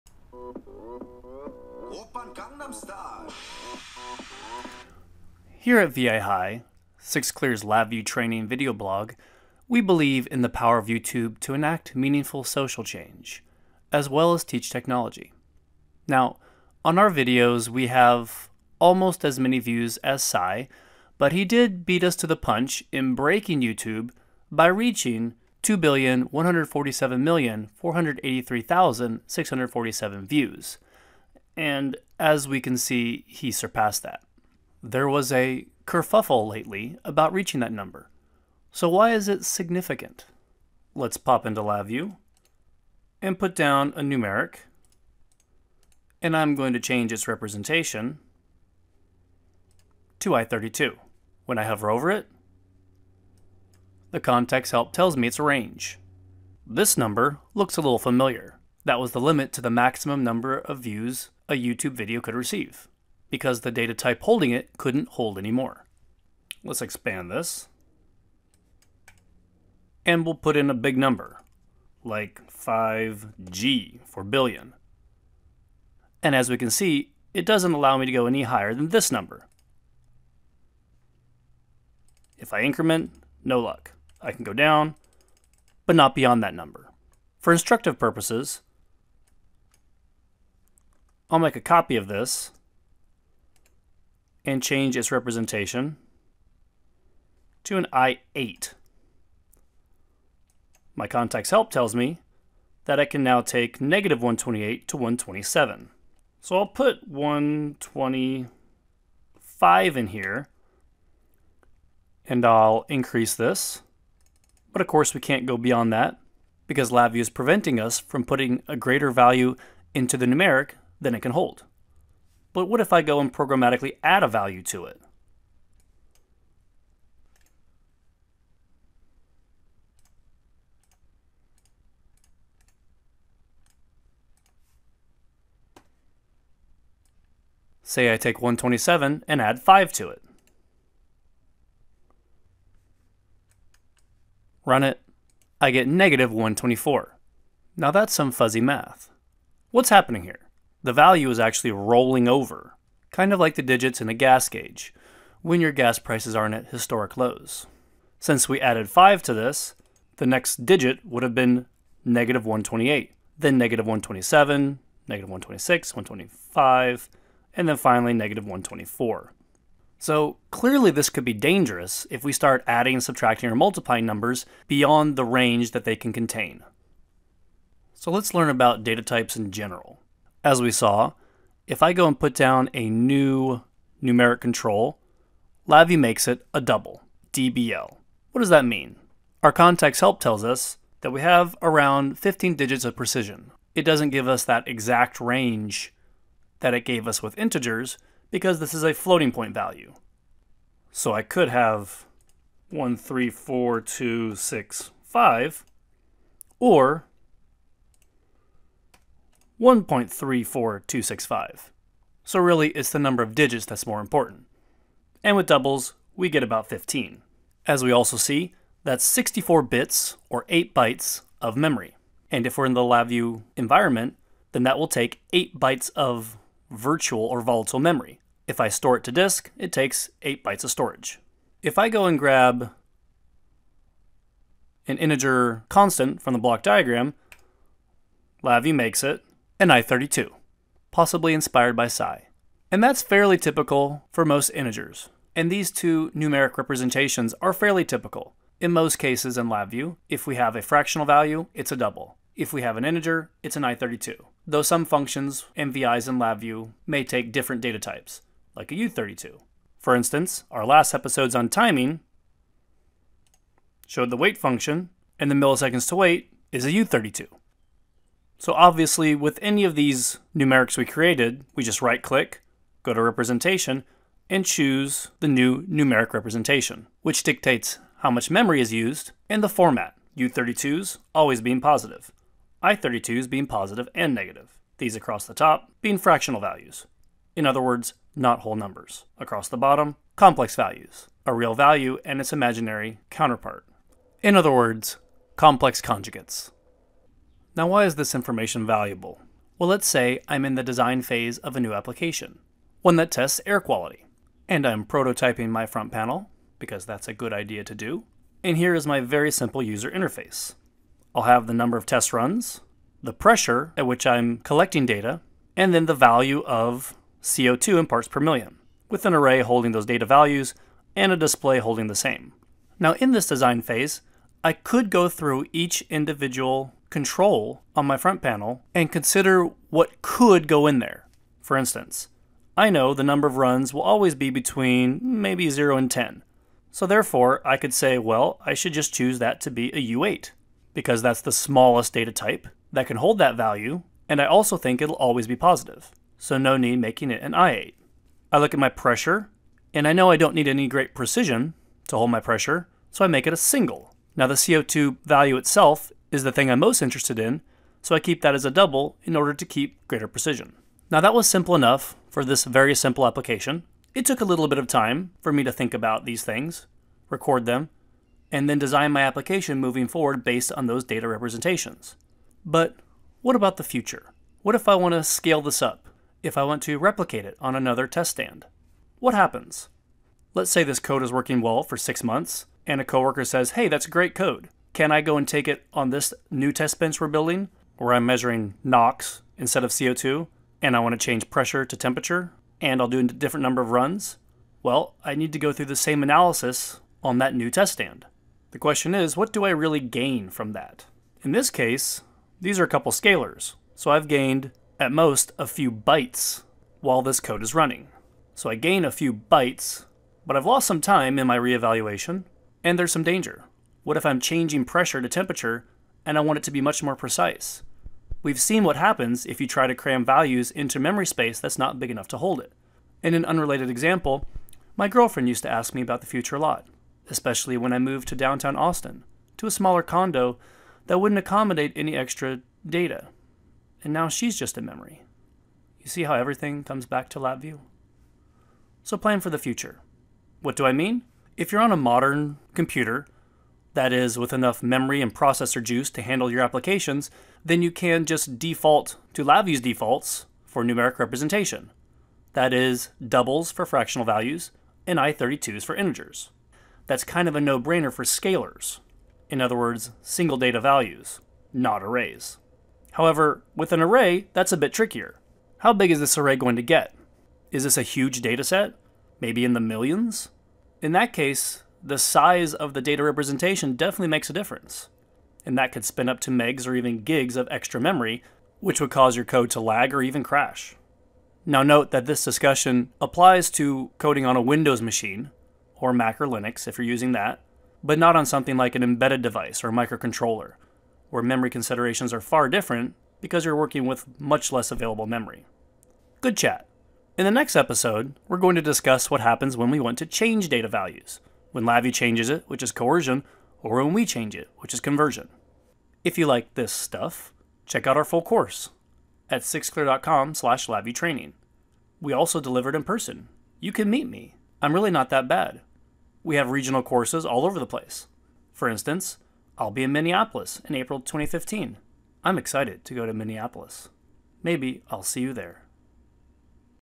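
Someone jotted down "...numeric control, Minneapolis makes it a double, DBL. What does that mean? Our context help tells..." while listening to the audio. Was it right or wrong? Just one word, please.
wrong.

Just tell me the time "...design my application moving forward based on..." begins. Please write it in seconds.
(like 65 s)
368 s.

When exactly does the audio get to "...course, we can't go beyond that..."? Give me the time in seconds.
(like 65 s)
114 s.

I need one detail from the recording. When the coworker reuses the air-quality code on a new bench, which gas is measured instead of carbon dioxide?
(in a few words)
NOx.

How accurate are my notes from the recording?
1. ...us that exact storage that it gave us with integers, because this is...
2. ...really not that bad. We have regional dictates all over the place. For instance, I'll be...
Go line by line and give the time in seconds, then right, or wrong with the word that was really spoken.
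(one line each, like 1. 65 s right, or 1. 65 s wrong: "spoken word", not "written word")
1. 194 s wrong: "range", not "storage"
2. 514 s wrong: "courses", not "dictates".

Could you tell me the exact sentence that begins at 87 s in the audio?
For instructive purposes, I'll make a copy of this and change its representation to an I8.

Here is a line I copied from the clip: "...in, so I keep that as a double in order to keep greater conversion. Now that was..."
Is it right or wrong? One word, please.
wrong.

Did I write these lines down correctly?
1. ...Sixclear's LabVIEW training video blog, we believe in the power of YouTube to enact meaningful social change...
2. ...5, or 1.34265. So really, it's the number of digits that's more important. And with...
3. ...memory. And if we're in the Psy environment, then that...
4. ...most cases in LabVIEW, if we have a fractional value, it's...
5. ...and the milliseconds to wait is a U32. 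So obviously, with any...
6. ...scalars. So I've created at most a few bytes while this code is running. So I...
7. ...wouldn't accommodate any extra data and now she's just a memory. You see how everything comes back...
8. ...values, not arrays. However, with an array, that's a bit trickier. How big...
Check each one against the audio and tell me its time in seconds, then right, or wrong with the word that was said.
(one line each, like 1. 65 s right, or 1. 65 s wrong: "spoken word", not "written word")
1. 6 s right
2. 205 s right
3. 221 s wrong: "LabVIEW", not "Psy"
4. 248 s right
5. 265 s right
6. 402 s wrong: "gained", not "created"
7. 430 s right
8. 460 s right.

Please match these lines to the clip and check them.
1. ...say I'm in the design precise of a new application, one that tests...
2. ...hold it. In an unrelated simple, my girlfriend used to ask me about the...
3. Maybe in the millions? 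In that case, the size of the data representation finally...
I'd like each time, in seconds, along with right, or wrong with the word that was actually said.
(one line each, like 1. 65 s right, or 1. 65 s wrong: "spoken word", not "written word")
1. 299 s wrong: "phase", not "precise"
2. 422 s wrong: "example", not "simple"
3. 469 s wrong: "definitely", not "finally".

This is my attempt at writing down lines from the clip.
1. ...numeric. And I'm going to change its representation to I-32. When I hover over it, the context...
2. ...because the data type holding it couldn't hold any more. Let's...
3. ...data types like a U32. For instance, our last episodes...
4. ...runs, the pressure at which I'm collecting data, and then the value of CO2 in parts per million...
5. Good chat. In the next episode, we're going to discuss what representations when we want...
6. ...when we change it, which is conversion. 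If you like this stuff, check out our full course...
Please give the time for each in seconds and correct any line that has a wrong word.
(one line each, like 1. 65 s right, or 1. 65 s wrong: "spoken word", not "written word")
1. 44 s right
2. 63 s right
3. 257 s right
4. 312 s right
5. 496 s wrong: "happens", not "representations"
6. 503 s right.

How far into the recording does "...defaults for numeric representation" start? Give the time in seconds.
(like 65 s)
449 s.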